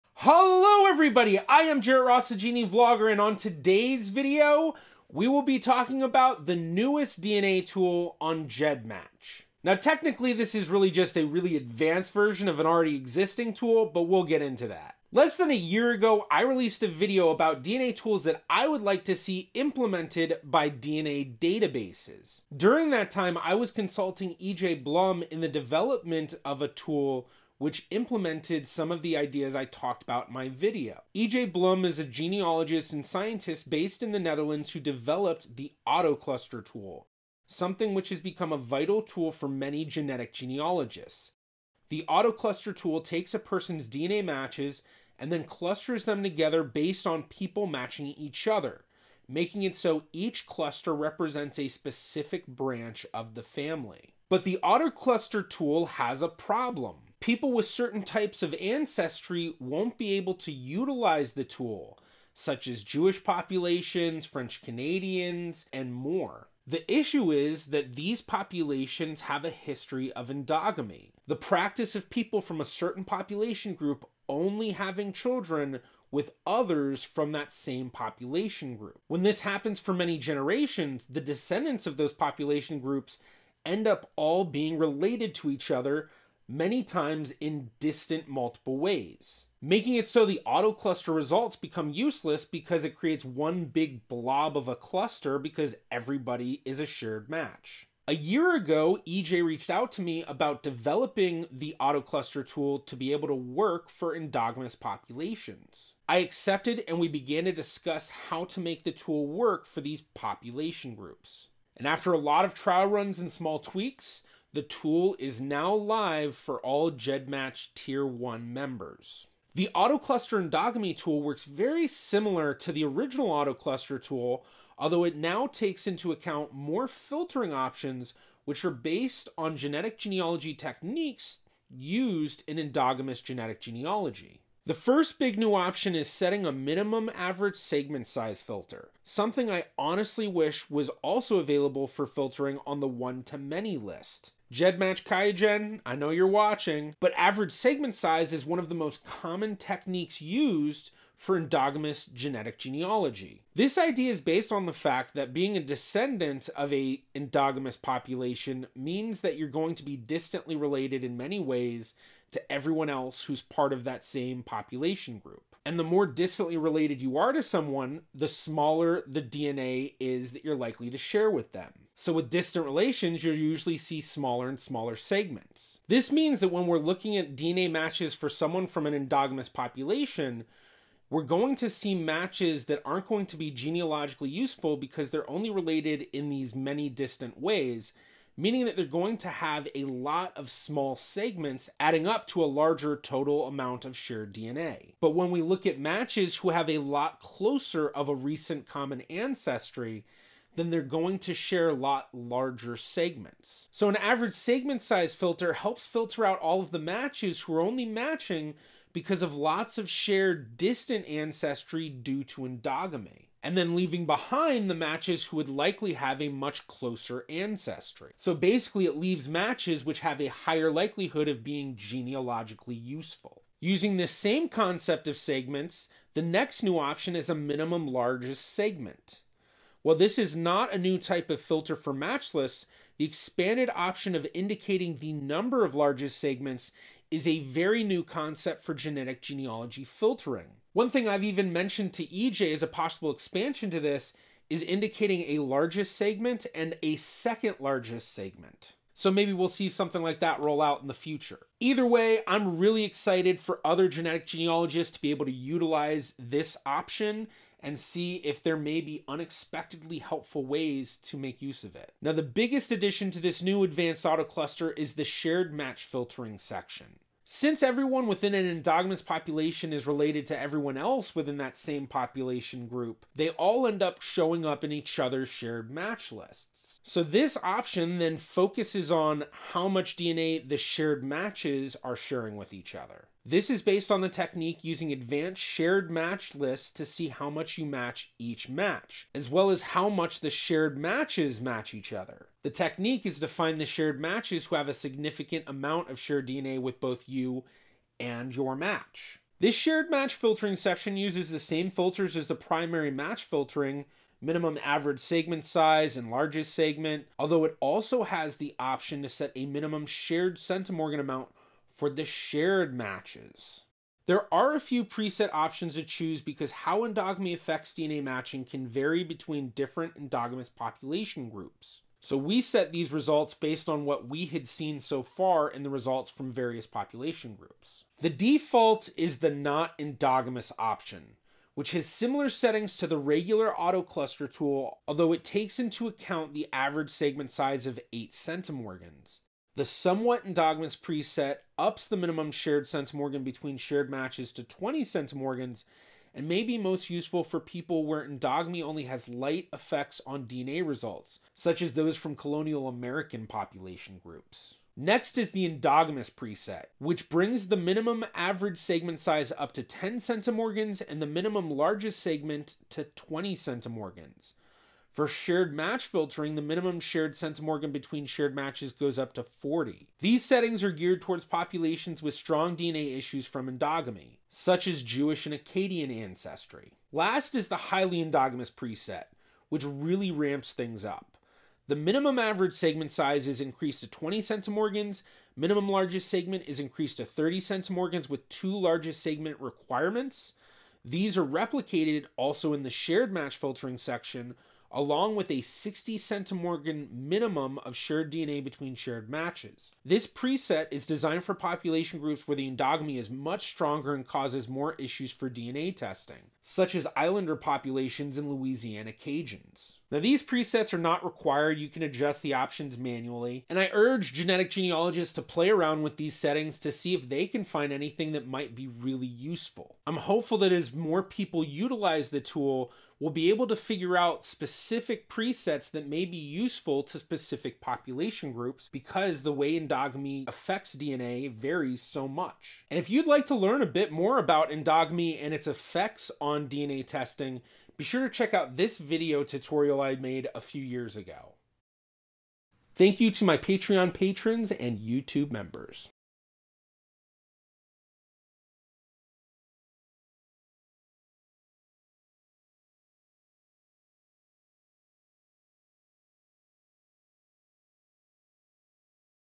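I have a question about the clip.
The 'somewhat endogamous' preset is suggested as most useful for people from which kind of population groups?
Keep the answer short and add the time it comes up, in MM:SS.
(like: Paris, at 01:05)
colonial American, at 05:52.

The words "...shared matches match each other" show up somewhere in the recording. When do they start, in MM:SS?
04:50.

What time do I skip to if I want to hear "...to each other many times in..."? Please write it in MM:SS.
01:25.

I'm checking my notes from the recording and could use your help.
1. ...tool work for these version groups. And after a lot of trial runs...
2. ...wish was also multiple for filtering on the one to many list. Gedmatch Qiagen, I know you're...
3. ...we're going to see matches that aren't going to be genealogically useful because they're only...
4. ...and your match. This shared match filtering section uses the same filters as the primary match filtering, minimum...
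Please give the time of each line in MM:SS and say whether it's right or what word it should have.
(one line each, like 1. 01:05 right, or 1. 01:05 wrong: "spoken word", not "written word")
1. 01:48 wrong: "population", not "version"
2. 02:20 wrong: "available", not "multiple"
3. 03:01 right
4. 04:57 right.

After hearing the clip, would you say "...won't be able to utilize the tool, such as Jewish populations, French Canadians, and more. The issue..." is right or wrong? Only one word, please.
right.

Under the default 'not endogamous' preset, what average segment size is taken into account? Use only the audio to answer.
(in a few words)
8 centimorgans.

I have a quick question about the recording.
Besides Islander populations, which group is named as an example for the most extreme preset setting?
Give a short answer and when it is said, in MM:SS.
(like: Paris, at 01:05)
Louisiana Cajuns, at 06:48.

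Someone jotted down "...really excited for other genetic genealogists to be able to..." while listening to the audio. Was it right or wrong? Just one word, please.
right.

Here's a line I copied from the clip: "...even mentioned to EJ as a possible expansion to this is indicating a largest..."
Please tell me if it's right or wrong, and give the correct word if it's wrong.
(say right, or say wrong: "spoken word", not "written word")
right.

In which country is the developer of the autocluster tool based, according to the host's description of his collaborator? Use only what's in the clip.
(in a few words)
Netherlands.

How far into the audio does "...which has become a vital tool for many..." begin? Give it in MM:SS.
00:37.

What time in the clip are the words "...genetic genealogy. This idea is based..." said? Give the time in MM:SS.
02:32.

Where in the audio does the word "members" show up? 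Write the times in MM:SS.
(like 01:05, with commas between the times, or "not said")
01:58, 07:25.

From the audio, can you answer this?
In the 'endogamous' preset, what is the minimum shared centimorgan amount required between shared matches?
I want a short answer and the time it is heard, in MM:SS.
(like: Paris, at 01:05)
40, at 06:09.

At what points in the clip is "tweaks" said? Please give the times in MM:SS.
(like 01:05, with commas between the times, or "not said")
01:53.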